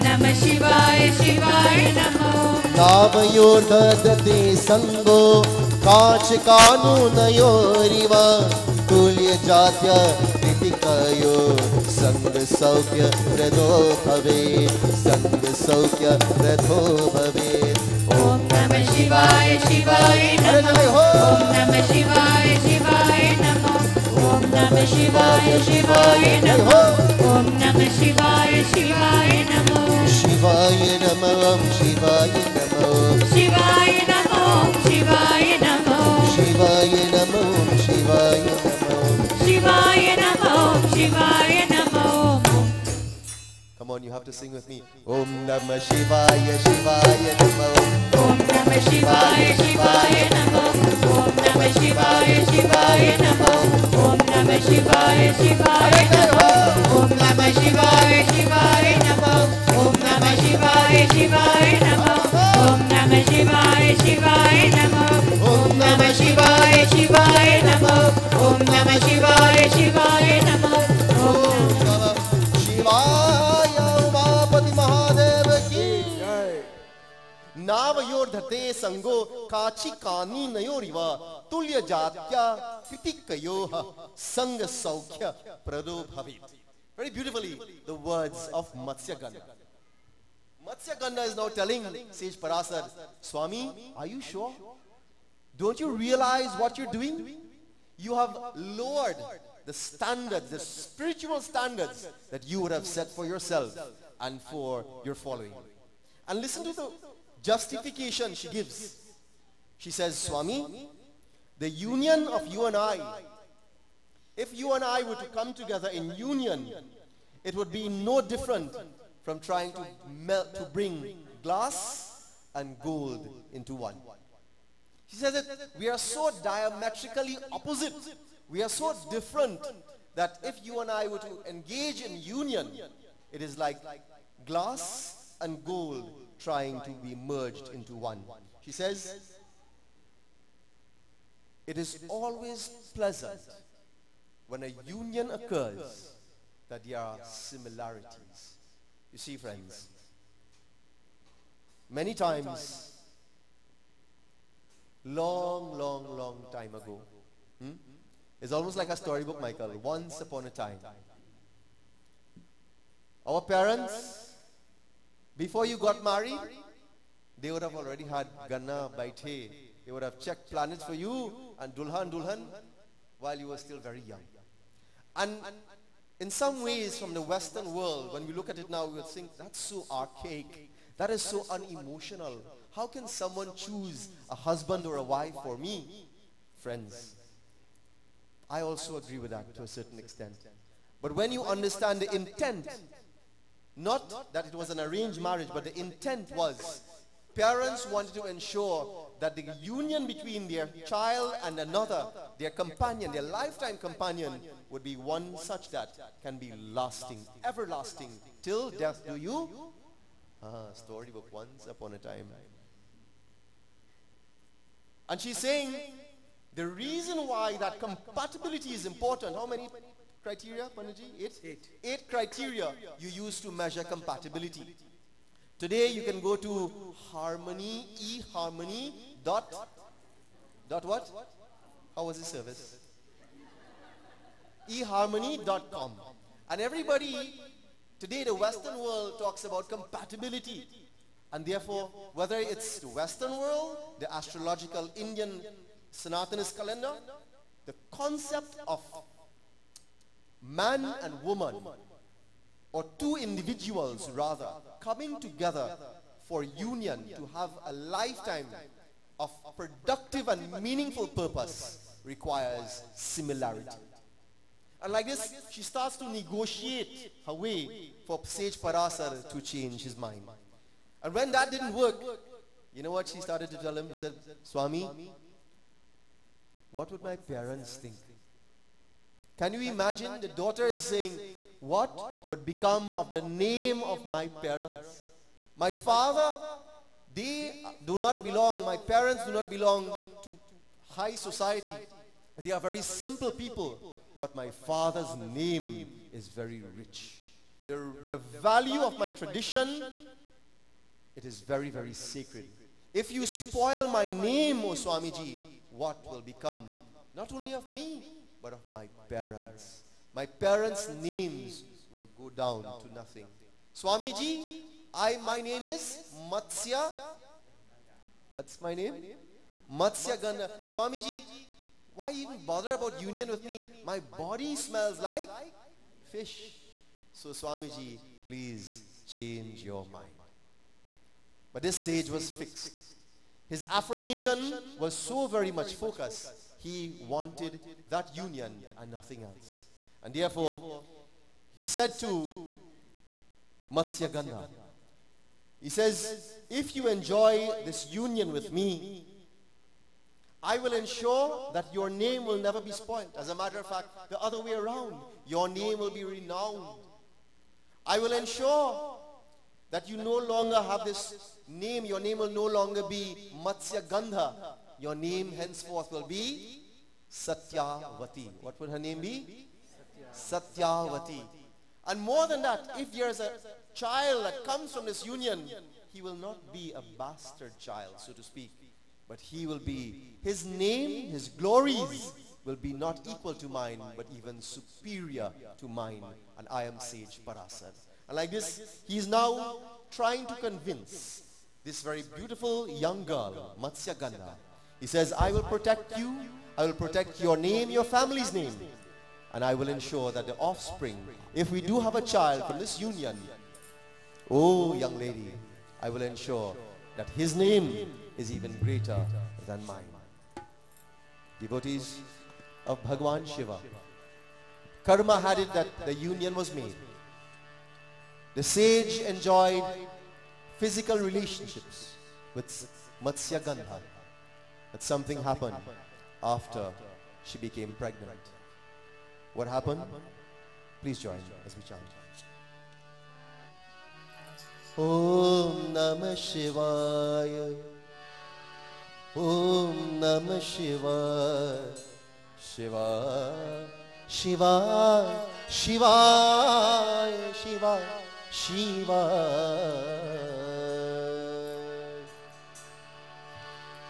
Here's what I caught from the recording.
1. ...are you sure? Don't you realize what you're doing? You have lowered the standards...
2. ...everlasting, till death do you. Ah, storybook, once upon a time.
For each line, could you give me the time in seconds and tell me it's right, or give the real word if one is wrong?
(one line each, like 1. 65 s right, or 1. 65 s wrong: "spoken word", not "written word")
1. 93 s right
2. 207 s right.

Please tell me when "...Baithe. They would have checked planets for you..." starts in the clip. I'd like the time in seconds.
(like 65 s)
168 s.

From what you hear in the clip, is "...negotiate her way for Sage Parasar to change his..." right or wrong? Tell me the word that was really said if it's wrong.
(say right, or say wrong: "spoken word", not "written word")
right.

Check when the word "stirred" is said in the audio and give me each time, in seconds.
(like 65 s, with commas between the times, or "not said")
not said.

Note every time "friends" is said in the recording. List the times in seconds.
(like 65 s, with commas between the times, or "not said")
149 s, 186 s.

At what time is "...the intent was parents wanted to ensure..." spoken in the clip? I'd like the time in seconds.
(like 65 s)
195 s.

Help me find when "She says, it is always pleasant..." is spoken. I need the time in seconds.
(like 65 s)
138 s.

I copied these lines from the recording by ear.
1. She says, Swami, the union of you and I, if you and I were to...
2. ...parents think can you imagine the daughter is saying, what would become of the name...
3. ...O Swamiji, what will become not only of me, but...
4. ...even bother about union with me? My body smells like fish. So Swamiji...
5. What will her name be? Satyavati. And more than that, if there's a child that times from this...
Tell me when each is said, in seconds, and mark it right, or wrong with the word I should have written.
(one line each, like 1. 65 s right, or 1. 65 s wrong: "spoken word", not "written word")
1. 109 s right
2. 277 s right
3. 304 s right
4. 322 s right
5. 368 s wrong: "comes", not "times".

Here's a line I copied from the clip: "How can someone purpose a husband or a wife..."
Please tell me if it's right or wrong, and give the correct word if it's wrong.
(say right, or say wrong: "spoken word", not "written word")
wrong: "choose", not "purpose".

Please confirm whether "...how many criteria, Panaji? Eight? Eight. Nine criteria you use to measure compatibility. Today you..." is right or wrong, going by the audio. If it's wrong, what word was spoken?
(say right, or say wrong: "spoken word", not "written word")
wrong: "Eight", not "Nine".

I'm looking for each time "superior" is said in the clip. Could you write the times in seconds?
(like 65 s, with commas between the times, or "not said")
384 s.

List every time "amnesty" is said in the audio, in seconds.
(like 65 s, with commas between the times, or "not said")
not said.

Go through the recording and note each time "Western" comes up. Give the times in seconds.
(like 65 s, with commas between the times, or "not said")
177 s, 238 s, 242 s.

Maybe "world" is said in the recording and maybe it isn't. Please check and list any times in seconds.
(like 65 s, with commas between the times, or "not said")
177 s, 238 s, 243 s.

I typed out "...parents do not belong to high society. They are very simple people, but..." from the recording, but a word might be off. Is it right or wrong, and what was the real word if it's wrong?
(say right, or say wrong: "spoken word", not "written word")
right.